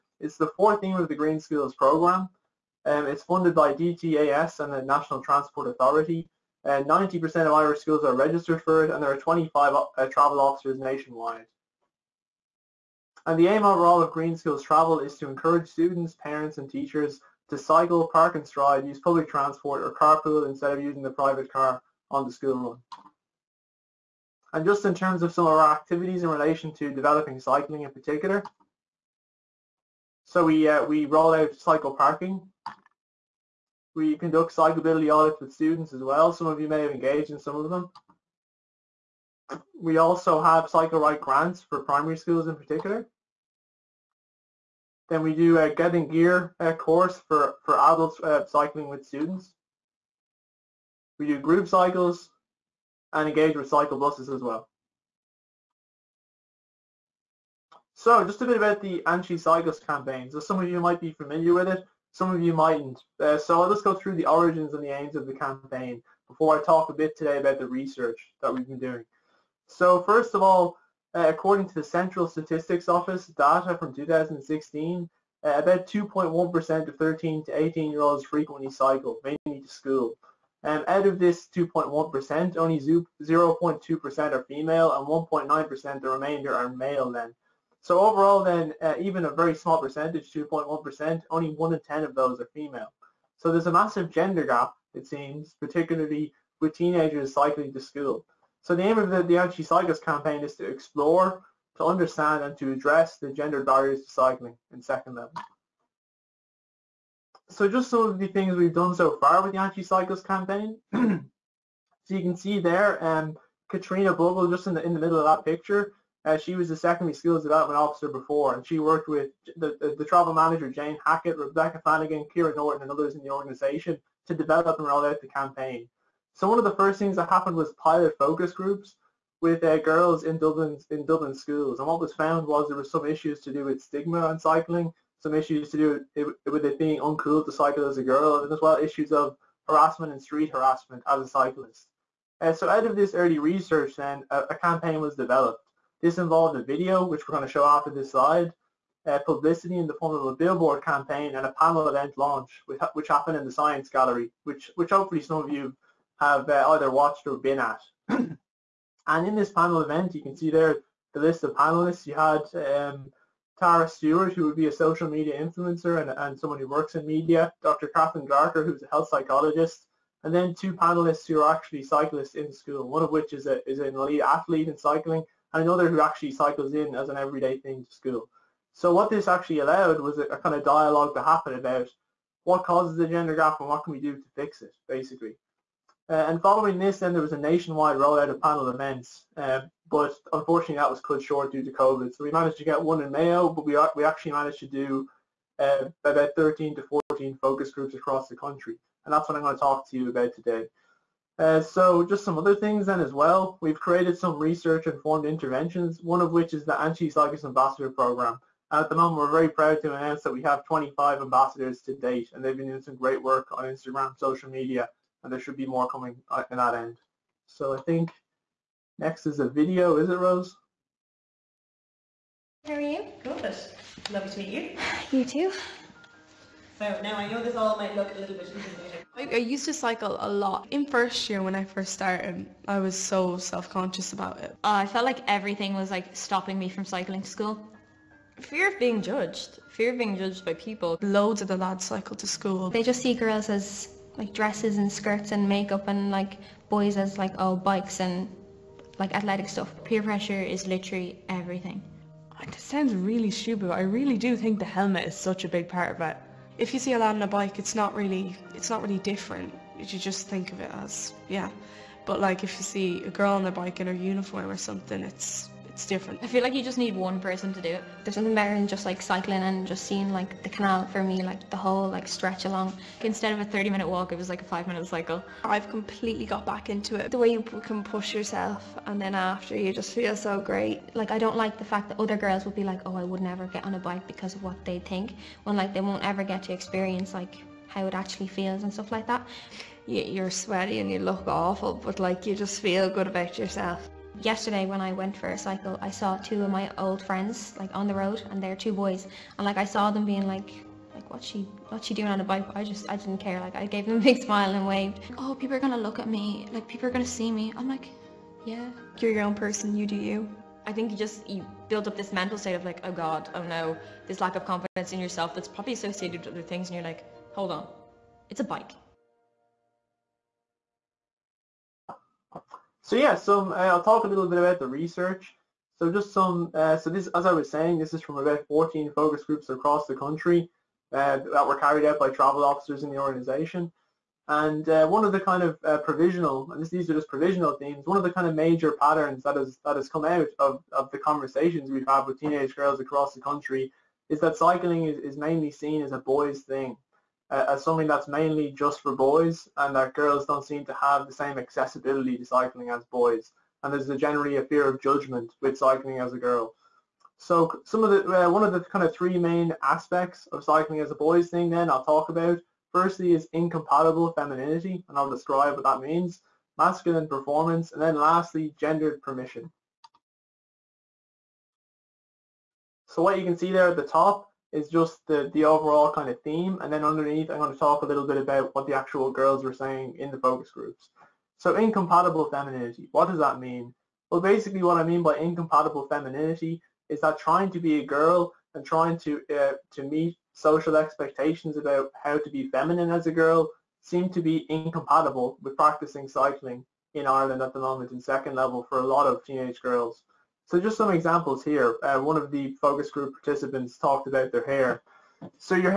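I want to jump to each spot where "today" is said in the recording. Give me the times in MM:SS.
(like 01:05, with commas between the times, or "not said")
01:07, 03:20.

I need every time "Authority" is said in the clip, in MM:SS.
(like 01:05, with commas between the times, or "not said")
00:05.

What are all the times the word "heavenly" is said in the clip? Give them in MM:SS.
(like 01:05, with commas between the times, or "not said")
not said.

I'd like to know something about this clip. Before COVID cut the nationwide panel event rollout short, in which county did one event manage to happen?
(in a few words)
Mayo.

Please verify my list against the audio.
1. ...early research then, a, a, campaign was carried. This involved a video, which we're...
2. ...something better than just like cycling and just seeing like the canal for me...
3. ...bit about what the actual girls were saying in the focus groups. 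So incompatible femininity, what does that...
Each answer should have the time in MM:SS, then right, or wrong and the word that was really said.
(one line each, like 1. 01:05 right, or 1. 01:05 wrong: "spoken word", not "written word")
1. 02:23 wrong: "developed", not "carried"
2. 04:28 right
3. 06:18 right.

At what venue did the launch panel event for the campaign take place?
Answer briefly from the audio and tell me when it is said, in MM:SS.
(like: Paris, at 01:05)
Science Gallery, at 02:33.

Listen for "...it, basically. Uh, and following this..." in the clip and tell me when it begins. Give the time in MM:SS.
03:04.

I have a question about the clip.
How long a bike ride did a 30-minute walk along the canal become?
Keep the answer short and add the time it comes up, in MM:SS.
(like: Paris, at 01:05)
5 minutes, at 04:34.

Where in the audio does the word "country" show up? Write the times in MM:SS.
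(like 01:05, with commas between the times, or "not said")
03:18, 05:29, 05:43.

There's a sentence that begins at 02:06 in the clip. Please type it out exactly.
So one of the first things that happened was pilot focus groups with uh, girls in Dublin in Dublin schools.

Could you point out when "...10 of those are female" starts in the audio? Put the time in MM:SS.
01:31.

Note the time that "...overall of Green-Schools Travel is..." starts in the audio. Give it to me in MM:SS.
00:13.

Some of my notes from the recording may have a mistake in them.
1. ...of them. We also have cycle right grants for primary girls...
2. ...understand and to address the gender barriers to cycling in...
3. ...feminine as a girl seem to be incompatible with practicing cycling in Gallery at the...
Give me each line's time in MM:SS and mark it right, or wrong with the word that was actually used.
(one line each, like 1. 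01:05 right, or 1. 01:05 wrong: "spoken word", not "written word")
1. 00:37 wrong: "schools", not "girls"
2. 01:41 right
3. 06:32 wrong: "Ireland", not "Gallery".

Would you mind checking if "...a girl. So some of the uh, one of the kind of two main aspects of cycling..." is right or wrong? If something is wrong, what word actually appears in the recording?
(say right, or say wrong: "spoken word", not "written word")
wrong: "three", not "two".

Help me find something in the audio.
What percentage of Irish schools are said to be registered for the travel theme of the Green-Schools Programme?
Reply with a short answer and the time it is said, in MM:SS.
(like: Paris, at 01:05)
90%, at 00:06.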